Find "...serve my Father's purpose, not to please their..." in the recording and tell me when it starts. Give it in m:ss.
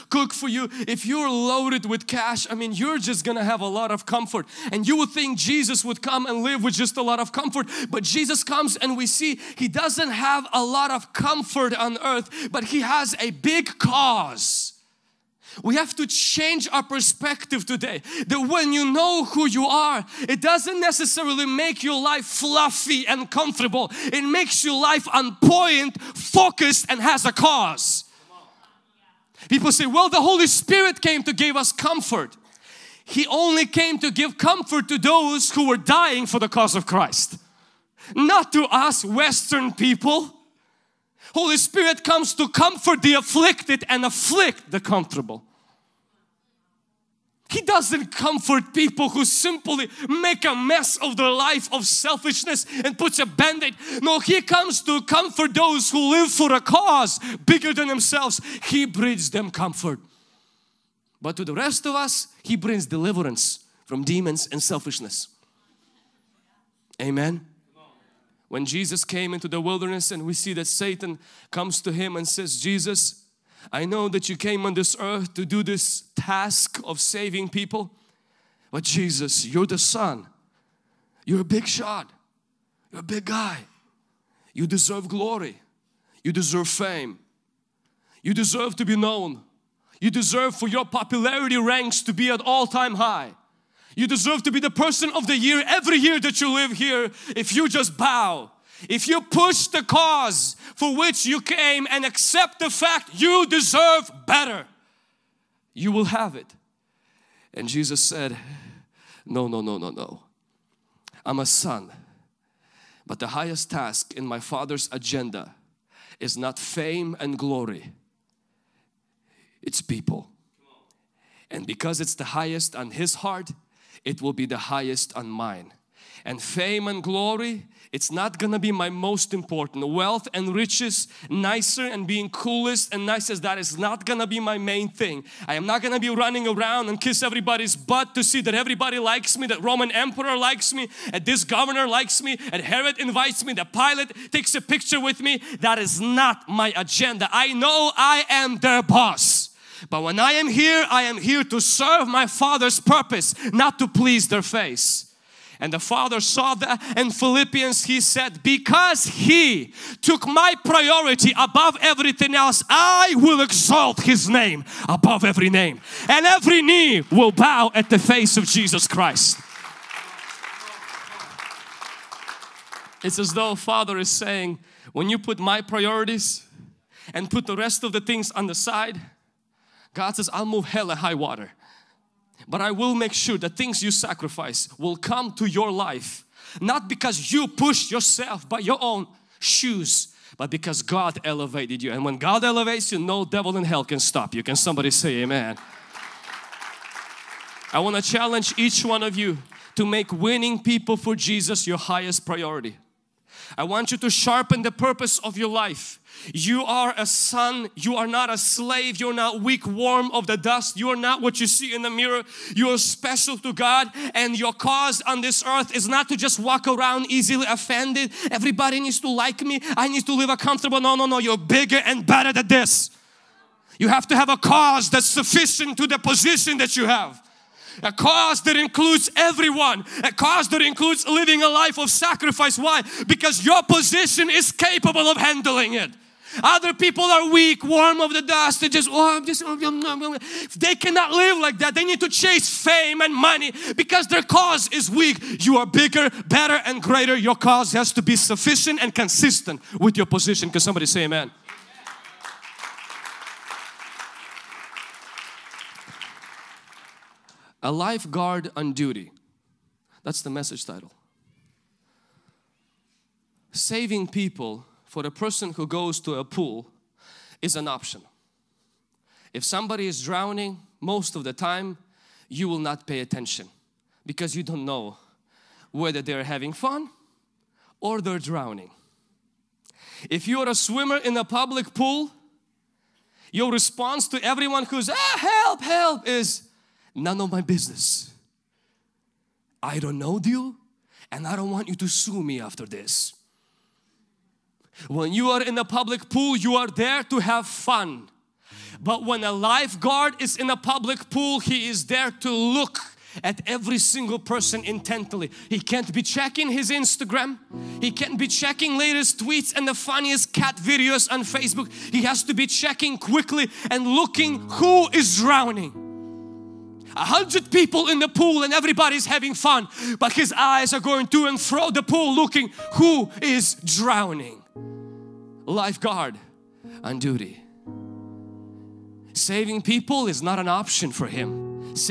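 2:31.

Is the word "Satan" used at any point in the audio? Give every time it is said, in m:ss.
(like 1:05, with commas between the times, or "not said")
1:10.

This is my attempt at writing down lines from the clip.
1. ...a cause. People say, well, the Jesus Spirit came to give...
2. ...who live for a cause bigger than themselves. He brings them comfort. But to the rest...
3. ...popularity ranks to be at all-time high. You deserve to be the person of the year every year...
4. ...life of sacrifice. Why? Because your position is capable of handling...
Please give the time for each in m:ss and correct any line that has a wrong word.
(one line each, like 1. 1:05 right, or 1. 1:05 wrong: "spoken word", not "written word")
1. 0:27 wrong: "Holy", not "Jesus"
2. 0:55 right
3. 1:30 right
4. 3:51 right.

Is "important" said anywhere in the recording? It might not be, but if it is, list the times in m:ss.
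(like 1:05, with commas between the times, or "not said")
2:09.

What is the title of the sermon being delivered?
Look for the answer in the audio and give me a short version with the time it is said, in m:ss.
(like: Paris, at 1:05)
A lifeguard on duty, at 4:17.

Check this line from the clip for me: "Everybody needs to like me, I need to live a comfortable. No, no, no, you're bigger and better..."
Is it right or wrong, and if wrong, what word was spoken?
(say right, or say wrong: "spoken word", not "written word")
right.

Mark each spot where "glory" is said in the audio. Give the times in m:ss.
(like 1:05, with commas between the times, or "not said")
1:25, 1:57, 2:07.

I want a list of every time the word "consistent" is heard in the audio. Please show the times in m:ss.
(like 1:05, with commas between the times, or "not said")
4:08.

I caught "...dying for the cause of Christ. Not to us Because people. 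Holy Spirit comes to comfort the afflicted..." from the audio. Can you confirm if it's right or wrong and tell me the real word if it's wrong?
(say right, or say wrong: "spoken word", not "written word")
wrong: "Western", not "Because".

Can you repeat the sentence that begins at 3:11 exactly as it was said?
And when God elevates you, no devil in hell can stop you.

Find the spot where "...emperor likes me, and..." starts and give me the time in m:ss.
2:19.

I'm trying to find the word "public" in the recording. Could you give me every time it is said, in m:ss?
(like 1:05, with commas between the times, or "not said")
4:41, 4:55, 5:00.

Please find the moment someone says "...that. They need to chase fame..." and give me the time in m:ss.
4:01.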